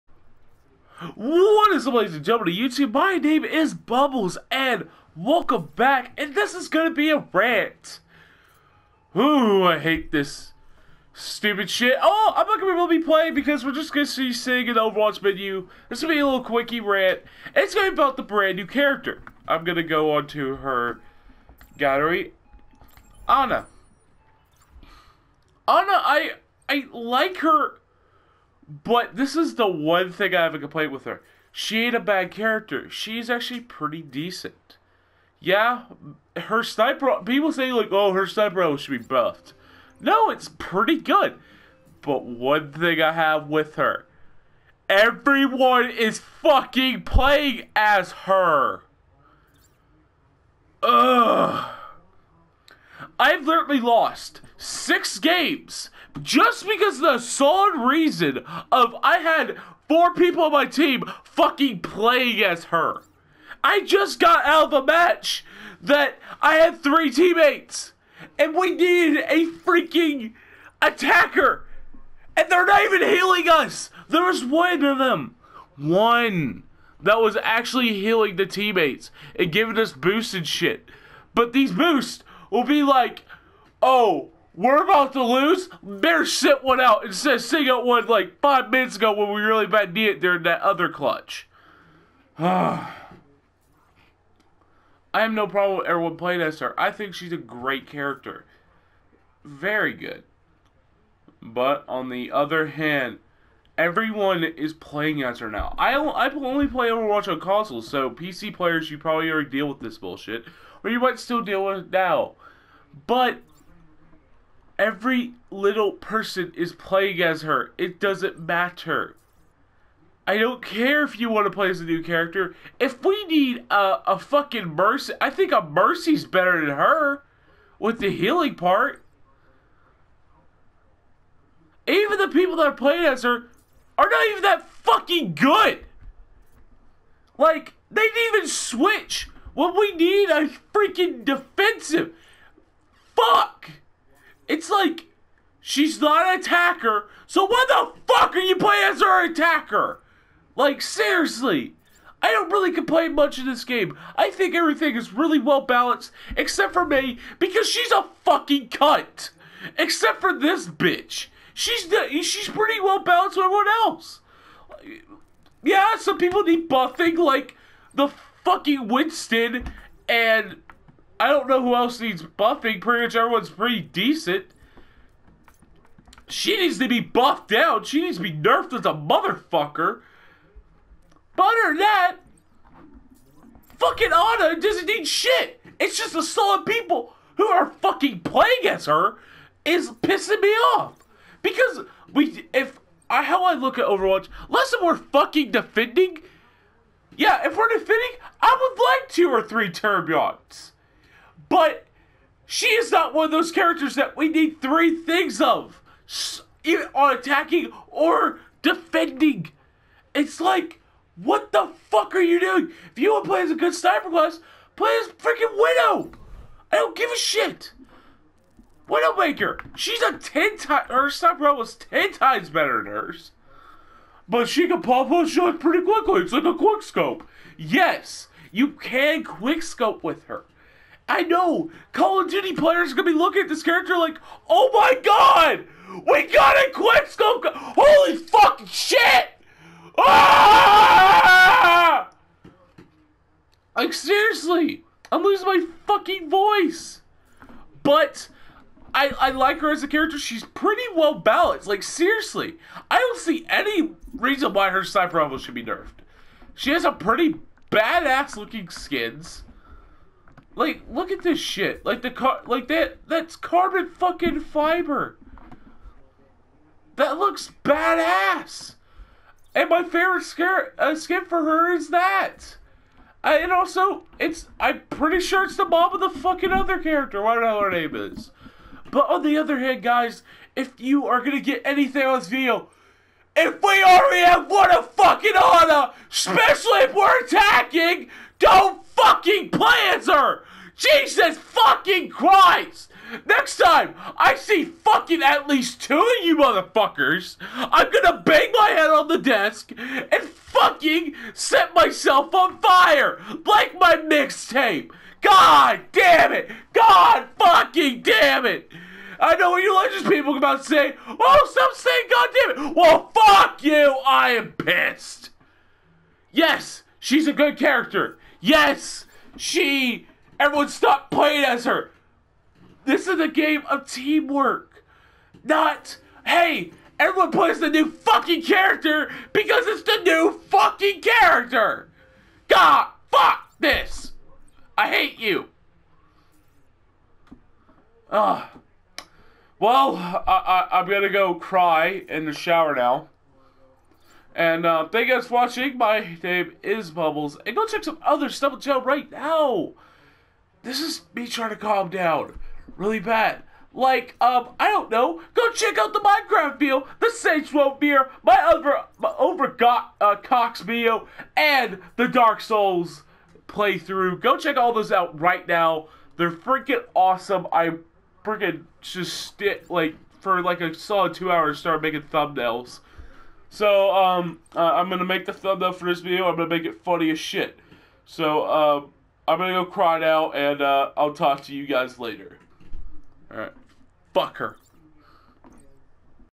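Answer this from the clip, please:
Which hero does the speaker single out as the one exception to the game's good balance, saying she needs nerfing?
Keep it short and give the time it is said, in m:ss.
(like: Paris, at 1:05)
Mei, at 2:36.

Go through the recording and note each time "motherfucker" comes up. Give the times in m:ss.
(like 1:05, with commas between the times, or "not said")
2:58, 4:56.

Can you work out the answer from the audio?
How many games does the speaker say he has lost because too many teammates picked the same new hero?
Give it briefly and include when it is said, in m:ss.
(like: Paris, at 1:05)
6, at 0:54.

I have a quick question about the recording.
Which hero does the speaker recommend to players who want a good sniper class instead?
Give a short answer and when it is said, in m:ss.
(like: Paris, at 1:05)
Widowmaker, at 3:38.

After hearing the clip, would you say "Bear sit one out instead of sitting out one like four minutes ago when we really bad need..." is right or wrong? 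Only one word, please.
wrong.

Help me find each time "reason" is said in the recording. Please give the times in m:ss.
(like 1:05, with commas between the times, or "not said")
0:57, 4:14.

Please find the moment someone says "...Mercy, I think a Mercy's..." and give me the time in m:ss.
2:04.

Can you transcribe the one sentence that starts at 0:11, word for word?
Oh, I'm not gonna really be playing because we're just gonna see seeing an Overwatch menu.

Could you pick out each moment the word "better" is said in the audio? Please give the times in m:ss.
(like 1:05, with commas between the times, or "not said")
2:06, 3:42.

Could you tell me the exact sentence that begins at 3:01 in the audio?
But other than that, fucking Ana doesn't need shit.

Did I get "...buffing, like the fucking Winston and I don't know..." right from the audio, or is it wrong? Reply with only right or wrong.
right.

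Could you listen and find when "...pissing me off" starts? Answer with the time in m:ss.
3:09.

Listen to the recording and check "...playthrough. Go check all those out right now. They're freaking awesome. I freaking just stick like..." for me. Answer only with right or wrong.
right.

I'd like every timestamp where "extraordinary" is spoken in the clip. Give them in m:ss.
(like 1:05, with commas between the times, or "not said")
not said.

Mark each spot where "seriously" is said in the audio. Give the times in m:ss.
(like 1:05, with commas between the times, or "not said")
2:30, 4:03, 4:11.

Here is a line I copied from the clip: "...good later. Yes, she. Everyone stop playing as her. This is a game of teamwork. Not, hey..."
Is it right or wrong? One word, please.
wrong.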